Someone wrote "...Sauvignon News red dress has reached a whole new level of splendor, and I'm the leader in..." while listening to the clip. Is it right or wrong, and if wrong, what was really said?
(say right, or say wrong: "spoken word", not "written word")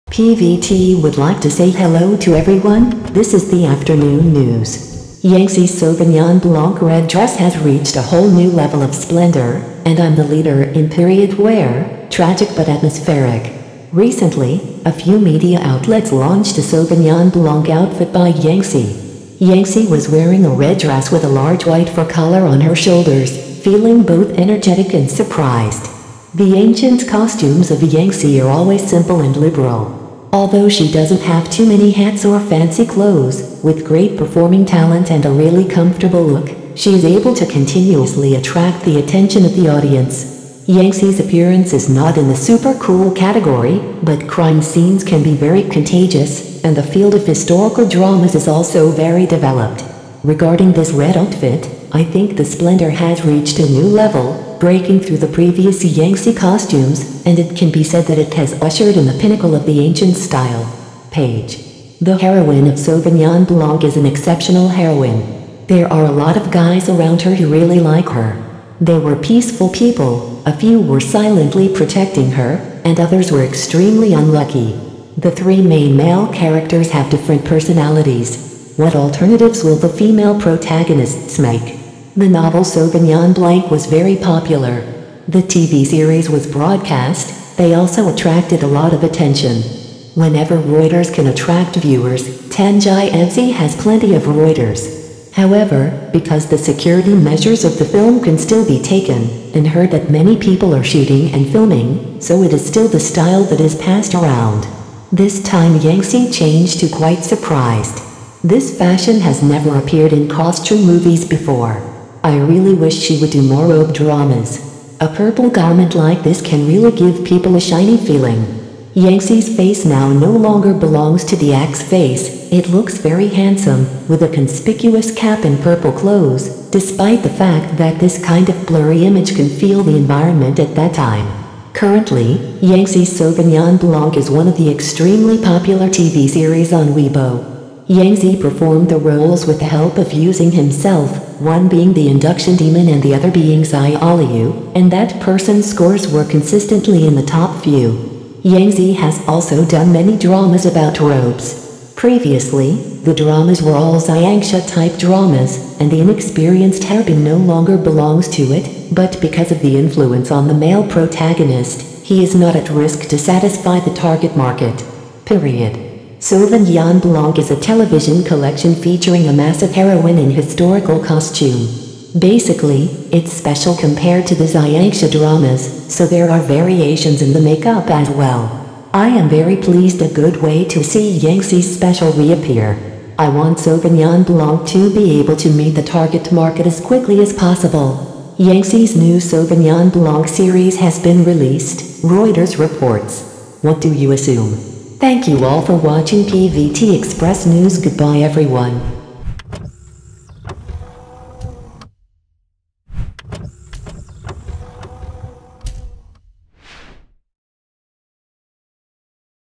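wrong: "Blanc", not "News".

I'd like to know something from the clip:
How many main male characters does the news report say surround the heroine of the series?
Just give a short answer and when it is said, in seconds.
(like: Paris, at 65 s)
3, at 75 s.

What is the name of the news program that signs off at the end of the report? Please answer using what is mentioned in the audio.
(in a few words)
PVT Express News.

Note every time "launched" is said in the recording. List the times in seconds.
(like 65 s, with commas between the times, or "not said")
16 s.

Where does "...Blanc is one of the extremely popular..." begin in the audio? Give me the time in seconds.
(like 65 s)
133 s.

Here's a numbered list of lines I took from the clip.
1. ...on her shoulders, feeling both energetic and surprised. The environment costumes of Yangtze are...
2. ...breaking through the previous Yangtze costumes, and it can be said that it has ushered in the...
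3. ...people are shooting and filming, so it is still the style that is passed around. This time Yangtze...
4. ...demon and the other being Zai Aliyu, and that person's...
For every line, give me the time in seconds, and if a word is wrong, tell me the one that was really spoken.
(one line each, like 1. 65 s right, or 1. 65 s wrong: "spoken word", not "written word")
1. 22 s wrong: "ancient", not "environment"
2. 54 s right
3. 100 s right
4. 142 s right.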